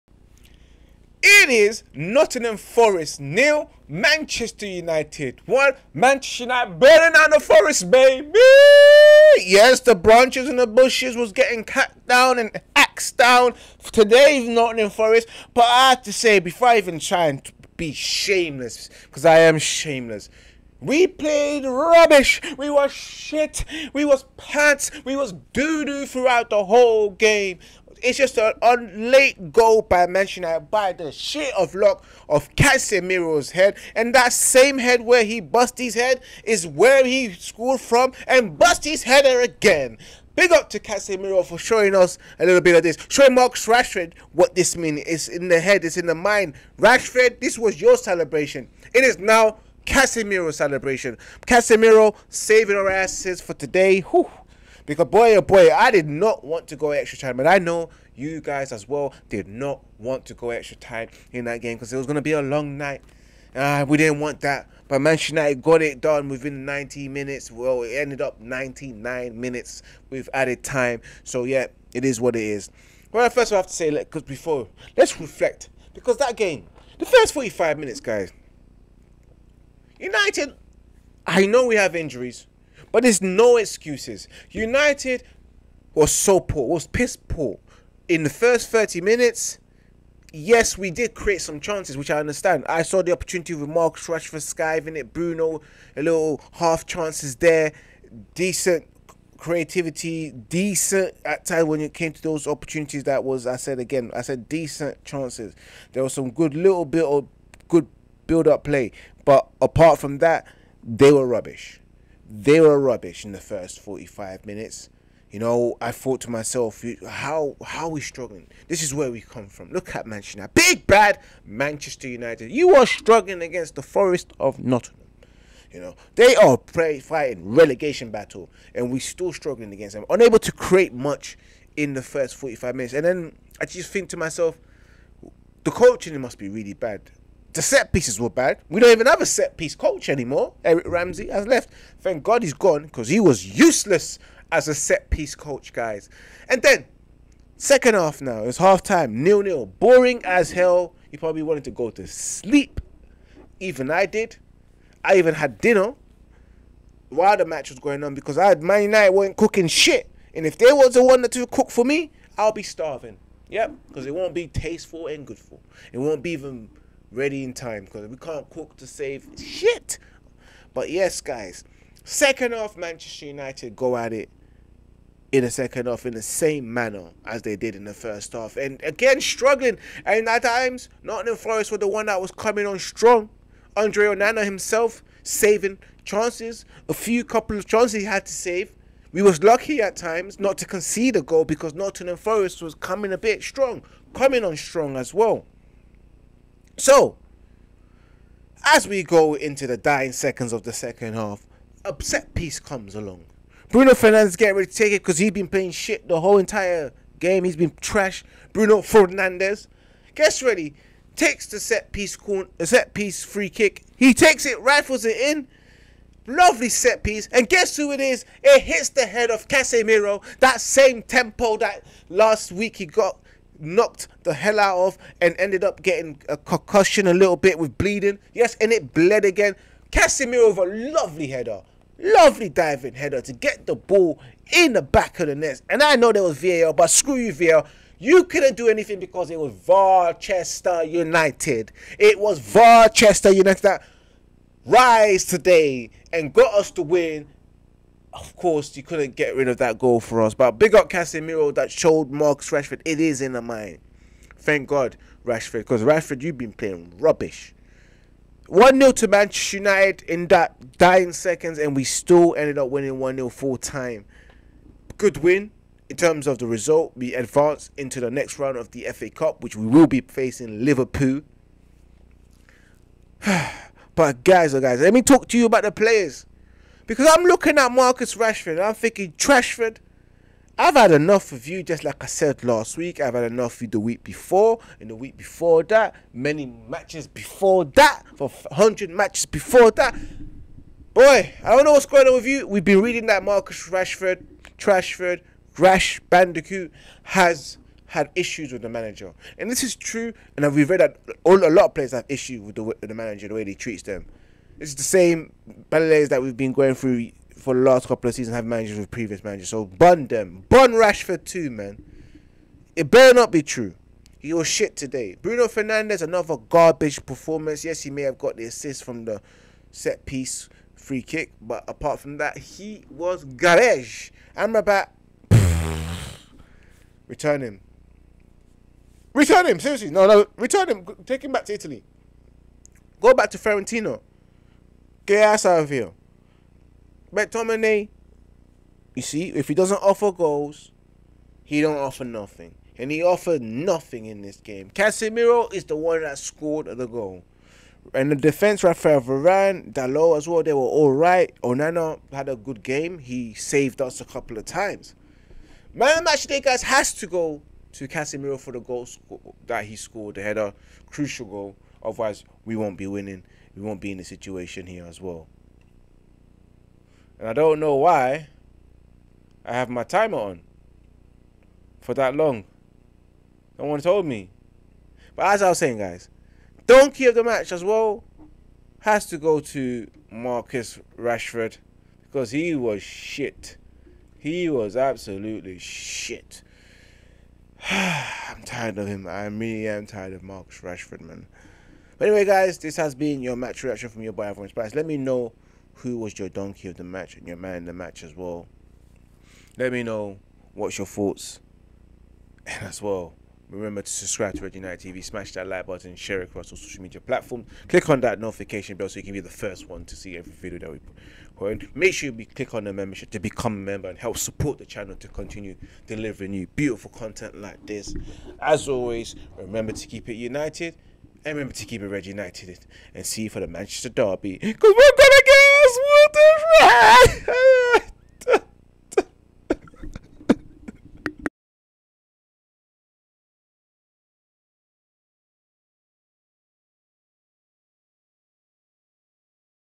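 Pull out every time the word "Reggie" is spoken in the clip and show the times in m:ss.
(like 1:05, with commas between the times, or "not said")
7:01.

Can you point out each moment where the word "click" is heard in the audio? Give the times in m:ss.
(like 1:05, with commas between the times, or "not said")
6:47, 6:52.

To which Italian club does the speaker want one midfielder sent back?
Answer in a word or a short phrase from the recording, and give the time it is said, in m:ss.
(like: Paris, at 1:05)
Fiorentina, at 5:32.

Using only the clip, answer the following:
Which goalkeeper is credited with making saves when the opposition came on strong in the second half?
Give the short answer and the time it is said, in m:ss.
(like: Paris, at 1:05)
Andre Onana, at 3:03.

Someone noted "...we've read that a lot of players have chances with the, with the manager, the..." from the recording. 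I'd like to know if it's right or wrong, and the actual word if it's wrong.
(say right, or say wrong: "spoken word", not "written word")
wrong: "issues", not "chances".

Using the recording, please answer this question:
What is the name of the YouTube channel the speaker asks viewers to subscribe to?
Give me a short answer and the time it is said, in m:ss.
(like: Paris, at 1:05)
Red United TV, at 6:43.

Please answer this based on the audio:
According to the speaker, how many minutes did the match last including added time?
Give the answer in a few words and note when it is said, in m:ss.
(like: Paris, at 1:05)
99, at 1:07.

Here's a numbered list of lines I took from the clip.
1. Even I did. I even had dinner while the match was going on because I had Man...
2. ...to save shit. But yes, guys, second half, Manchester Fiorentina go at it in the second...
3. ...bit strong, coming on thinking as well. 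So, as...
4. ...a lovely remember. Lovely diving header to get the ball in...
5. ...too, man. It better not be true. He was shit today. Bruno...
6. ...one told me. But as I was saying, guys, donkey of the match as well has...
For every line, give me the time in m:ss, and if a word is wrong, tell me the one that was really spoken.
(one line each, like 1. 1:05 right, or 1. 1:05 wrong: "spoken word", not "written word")
1. 2:33 right
2. 2:48 wrong: "United", not "Fiorentina"
3. 3:13 wrong: "strong", not "thinking"
4. 3:50 wrong: "header", not "remember"
5. 5:11 right
6. 6:13 right.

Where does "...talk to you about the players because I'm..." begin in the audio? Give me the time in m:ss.
4:35.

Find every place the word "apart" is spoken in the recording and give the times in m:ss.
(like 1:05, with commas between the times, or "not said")
1:49, 5:21.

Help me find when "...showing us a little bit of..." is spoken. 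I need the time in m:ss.
0:41.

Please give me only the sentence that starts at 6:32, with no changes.
But anyway, guys, this has been your match reaction from your boy Ivorian Spice.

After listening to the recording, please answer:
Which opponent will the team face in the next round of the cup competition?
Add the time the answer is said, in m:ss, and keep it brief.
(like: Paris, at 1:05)
Liverpool, at 4:29.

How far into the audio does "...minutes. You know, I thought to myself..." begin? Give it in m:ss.
1:54.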